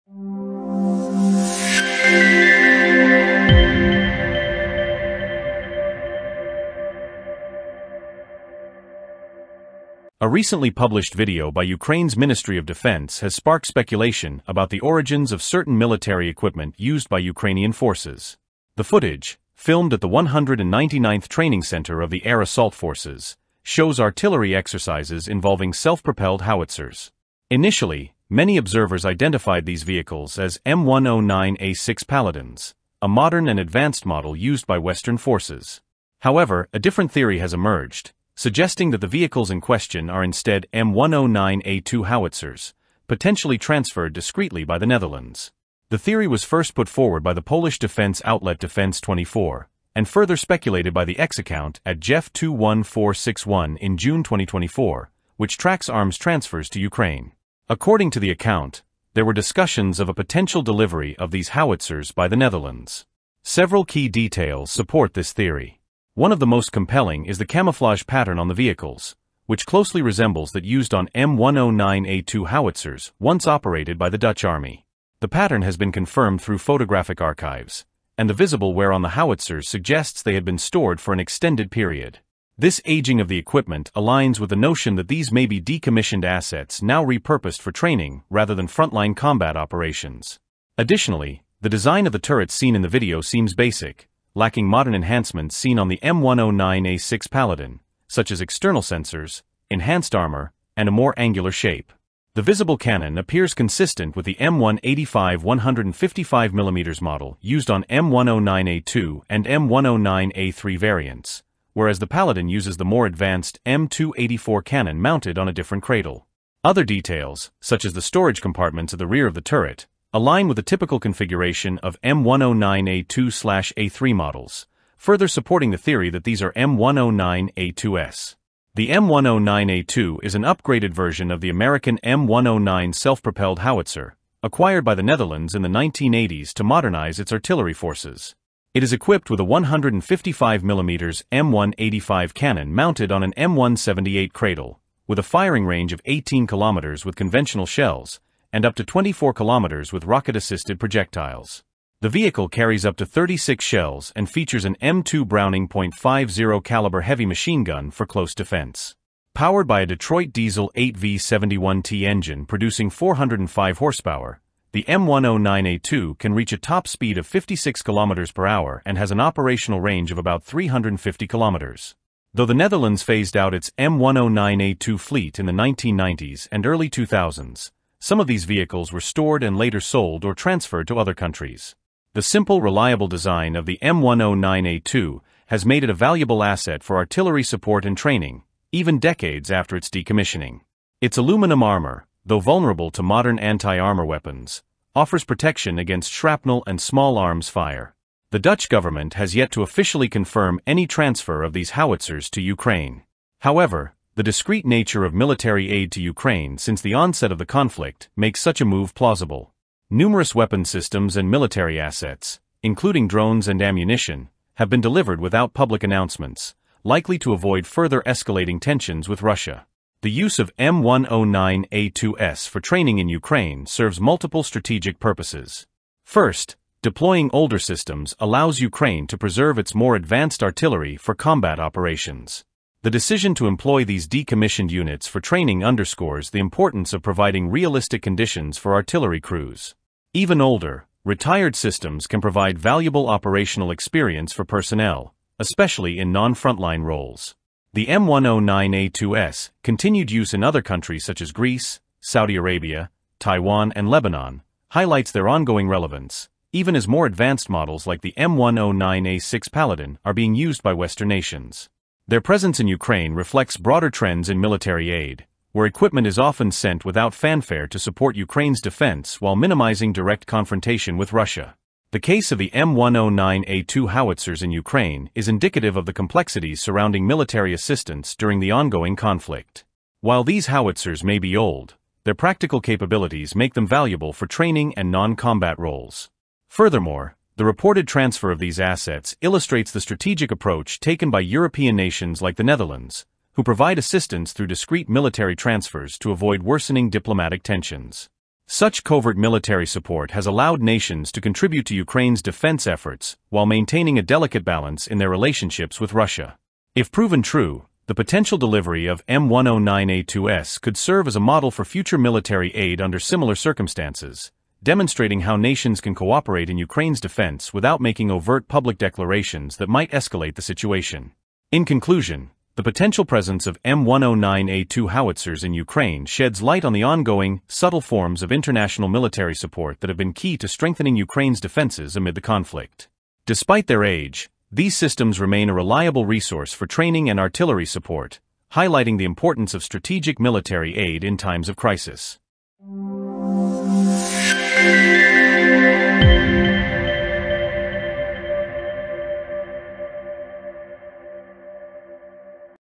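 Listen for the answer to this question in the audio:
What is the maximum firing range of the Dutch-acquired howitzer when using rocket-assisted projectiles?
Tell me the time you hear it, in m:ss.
2:28.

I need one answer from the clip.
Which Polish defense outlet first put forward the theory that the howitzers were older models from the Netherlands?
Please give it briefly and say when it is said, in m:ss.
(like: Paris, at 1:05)
Defense 24, at 0:48.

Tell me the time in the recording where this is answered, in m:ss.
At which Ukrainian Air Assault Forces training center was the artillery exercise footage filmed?
0:20.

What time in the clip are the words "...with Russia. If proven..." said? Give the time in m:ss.
5:05.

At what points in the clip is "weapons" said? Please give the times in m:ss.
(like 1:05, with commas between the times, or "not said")
3:14, 3:30.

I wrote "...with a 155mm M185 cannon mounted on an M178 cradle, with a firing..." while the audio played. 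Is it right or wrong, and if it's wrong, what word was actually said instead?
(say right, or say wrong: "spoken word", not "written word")
right.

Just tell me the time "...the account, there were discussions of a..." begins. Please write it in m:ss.
0:58.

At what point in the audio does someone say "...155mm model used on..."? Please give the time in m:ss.
1:45.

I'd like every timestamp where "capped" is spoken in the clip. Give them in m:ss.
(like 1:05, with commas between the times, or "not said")
not said.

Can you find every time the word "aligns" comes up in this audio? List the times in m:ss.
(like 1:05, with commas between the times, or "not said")
1:23, 2:00.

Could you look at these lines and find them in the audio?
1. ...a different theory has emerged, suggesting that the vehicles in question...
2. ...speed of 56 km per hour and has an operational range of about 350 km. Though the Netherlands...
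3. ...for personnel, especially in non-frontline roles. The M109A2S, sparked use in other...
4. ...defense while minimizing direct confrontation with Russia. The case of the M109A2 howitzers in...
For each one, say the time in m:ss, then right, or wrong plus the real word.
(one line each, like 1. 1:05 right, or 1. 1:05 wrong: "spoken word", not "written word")
1. 0:36 right
2. 2:46 right
3. 4:04 wrong: "continued", not "sparked"
4. 4:28 right.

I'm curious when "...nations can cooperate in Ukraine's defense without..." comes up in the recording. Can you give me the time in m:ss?
5:15.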